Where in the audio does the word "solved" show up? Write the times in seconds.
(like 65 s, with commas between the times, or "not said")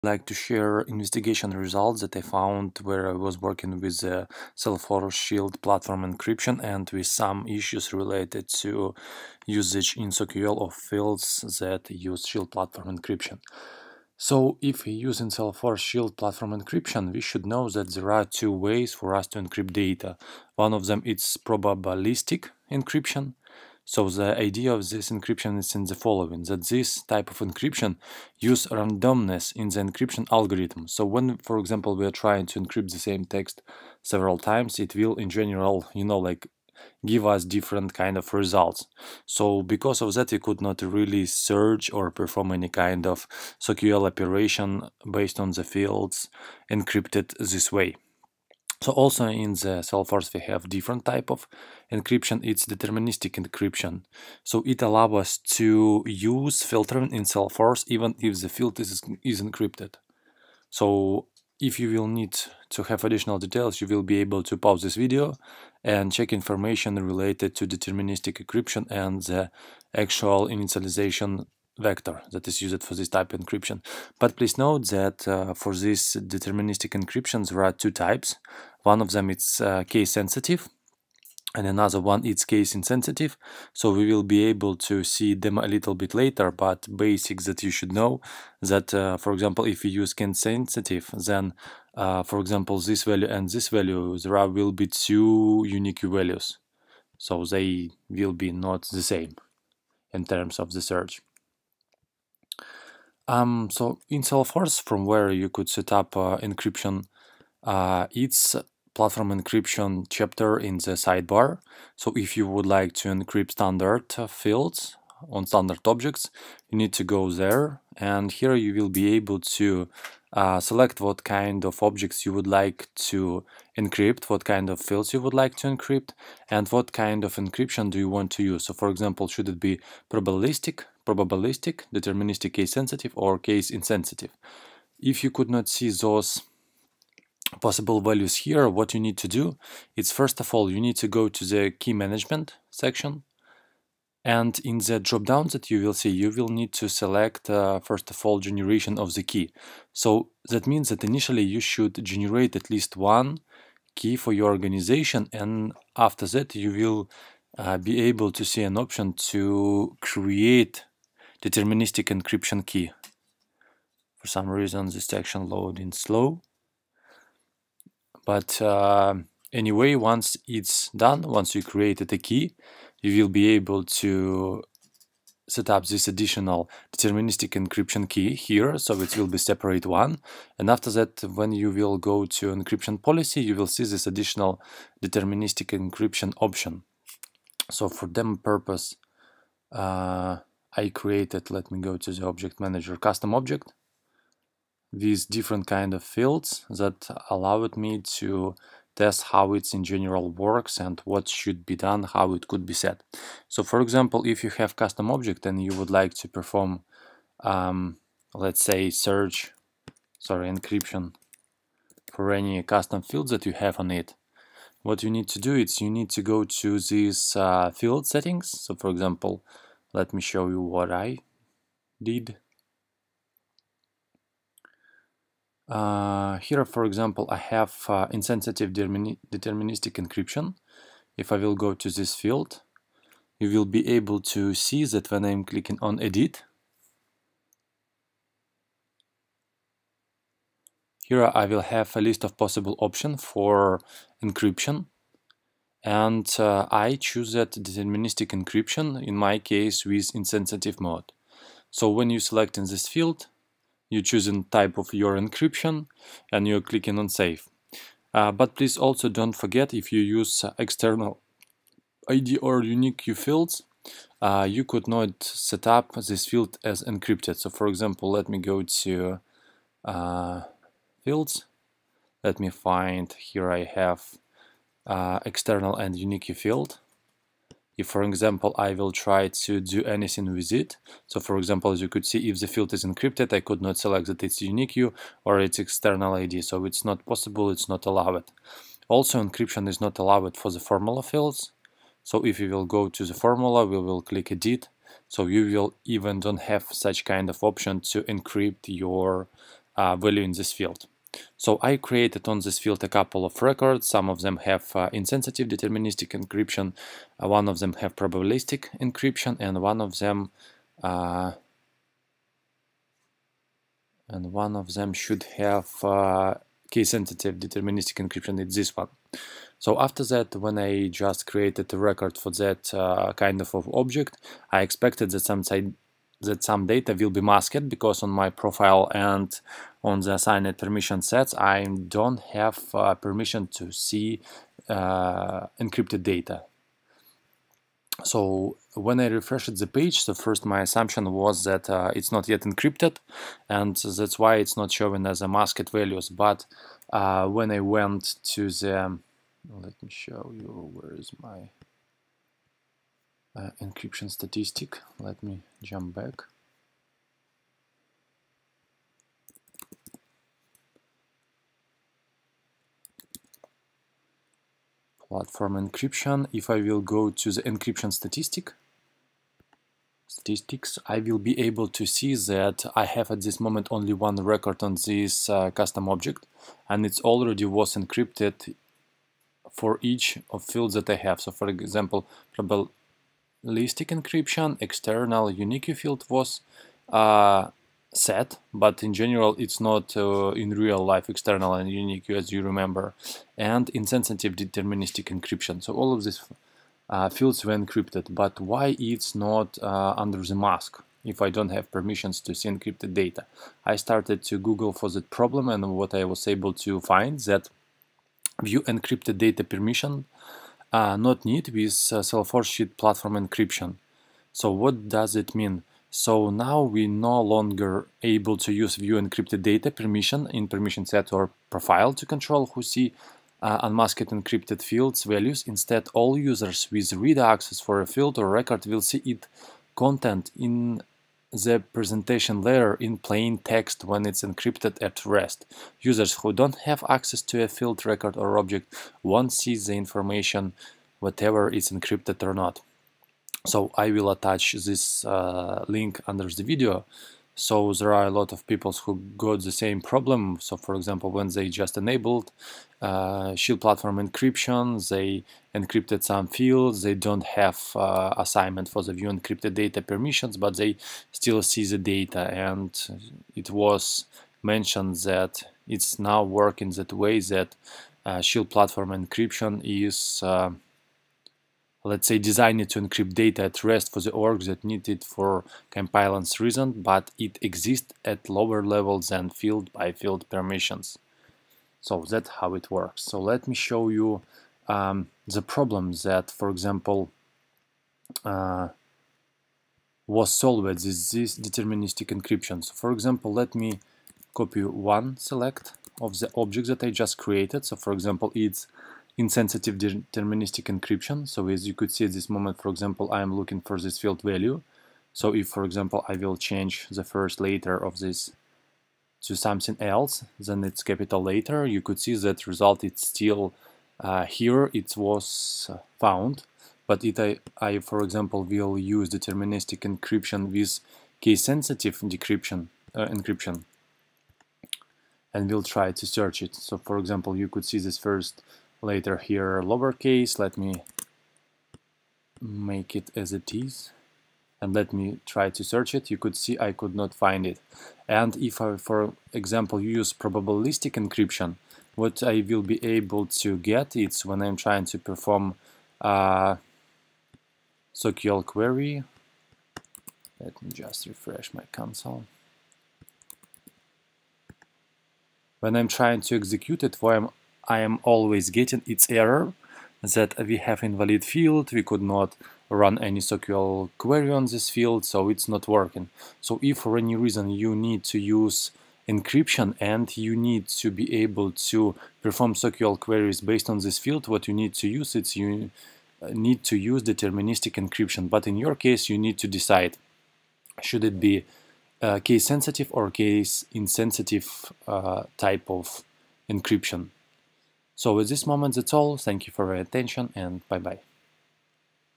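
490 s.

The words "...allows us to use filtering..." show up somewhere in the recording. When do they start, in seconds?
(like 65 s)
54 s.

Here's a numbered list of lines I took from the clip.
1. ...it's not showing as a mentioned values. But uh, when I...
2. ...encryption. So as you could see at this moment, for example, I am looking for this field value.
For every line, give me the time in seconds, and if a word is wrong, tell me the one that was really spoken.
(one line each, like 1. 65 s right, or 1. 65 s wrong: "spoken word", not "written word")
1. 344 s wrong: "masked", not "mentioned"
2. 500 s right.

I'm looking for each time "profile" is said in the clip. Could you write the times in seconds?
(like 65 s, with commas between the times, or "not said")
328 s, 421 s.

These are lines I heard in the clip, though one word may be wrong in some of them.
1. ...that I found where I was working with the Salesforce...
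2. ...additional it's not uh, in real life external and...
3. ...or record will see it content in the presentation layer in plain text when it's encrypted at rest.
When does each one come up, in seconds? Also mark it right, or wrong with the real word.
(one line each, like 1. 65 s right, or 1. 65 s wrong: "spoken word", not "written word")
1. 2 s right
2. 388 s wrong: "general", not "additional"
3. 428 s right.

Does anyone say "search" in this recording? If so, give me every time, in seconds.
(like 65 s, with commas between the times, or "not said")
41 s, 100 s, 208 s, 526 s, 535 s.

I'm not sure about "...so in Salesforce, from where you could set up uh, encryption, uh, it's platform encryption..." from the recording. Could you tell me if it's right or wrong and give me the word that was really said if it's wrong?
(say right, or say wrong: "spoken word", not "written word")
right.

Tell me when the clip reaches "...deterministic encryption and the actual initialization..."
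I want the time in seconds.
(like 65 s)
67 s.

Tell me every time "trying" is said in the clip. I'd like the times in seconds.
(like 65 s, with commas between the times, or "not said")
32 s, 544 s, 555 s.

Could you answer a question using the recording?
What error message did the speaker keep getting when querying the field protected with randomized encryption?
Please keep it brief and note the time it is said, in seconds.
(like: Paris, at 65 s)
Invalid field, at 560 s.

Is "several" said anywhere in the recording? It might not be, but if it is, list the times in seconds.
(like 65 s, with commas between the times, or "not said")
34 s.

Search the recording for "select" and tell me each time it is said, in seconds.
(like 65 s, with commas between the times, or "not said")
120 s, 146 s, 252 s, 283 s, 495 s.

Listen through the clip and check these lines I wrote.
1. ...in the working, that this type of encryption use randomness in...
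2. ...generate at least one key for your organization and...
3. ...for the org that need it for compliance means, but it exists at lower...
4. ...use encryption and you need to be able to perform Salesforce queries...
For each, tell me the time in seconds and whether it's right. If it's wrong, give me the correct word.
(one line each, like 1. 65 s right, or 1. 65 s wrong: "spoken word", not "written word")
1. 25 s wrong: "following", not "working"
2. 152 s right
3. 473 s wrong: "reasons", not "means"
4. 568 s wrong: "SQL", not "Salesforce".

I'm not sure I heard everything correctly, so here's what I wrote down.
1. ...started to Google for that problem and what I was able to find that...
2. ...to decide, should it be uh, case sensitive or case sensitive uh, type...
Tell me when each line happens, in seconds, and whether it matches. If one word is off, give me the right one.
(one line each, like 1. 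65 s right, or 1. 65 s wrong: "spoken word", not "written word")
1. 403 s right
2. 579 s wrong: "insensitive", not "sensitive".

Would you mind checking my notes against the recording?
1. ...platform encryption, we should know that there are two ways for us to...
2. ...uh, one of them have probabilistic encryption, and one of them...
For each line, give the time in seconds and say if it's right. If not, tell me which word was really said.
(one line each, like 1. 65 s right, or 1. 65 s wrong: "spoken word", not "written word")
1. 16 s right
2. 307 s right.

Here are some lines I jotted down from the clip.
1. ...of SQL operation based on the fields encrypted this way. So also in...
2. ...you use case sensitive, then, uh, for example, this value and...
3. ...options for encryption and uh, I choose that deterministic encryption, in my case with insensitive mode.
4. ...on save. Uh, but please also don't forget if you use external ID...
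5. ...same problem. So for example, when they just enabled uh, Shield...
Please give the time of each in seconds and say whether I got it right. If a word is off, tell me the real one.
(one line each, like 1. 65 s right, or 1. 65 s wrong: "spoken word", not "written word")
1. 43 s right
2. 89 s right
3. 242 s right
4. 256 s right
5. 449 s right.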